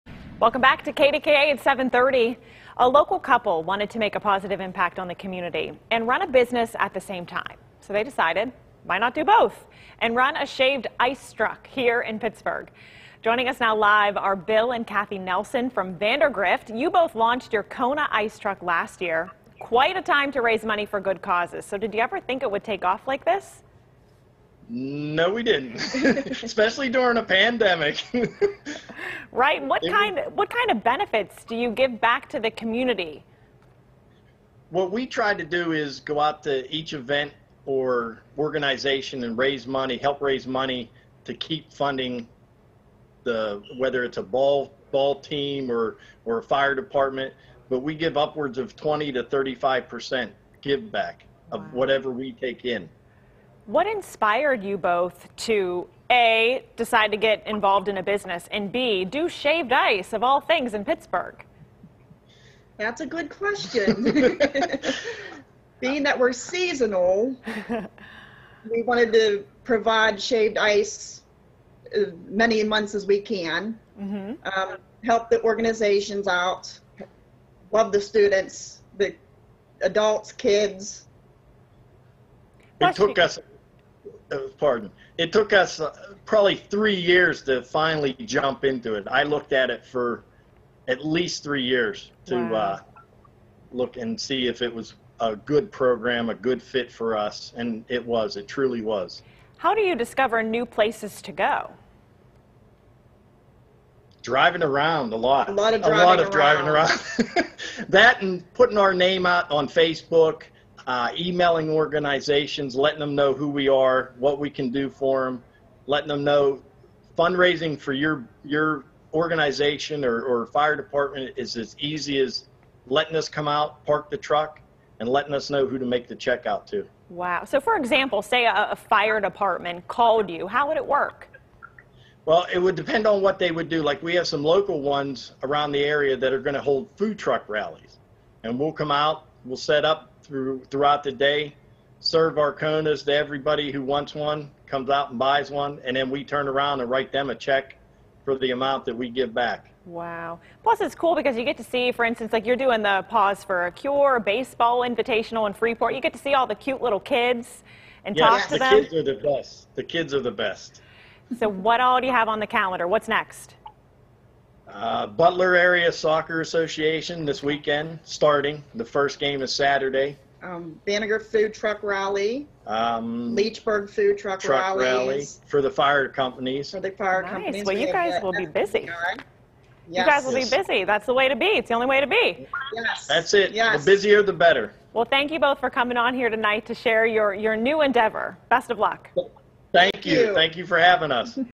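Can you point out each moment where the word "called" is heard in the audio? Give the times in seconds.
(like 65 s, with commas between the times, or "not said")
129 s.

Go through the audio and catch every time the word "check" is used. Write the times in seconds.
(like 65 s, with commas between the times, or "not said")
126 s, 147 s.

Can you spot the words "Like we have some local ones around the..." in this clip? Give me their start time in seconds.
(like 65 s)
133 s.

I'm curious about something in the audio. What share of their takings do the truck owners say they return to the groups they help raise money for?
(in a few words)
20 to 35%.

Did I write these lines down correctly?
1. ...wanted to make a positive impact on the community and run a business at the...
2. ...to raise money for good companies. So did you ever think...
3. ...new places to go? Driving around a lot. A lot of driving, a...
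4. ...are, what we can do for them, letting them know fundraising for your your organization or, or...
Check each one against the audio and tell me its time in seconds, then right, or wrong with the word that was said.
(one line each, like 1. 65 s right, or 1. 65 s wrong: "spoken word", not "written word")
1. 3 s right
2. 20 s wrong: "causes", not "companies"
3. 100 s right
4. 113 s right.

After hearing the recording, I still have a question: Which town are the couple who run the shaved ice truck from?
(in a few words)
Vandergrift.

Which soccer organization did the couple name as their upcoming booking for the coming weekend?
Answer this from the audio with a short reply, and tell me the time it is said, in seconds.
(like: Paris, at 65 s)
Butler Area Soccer Association, at 165 s.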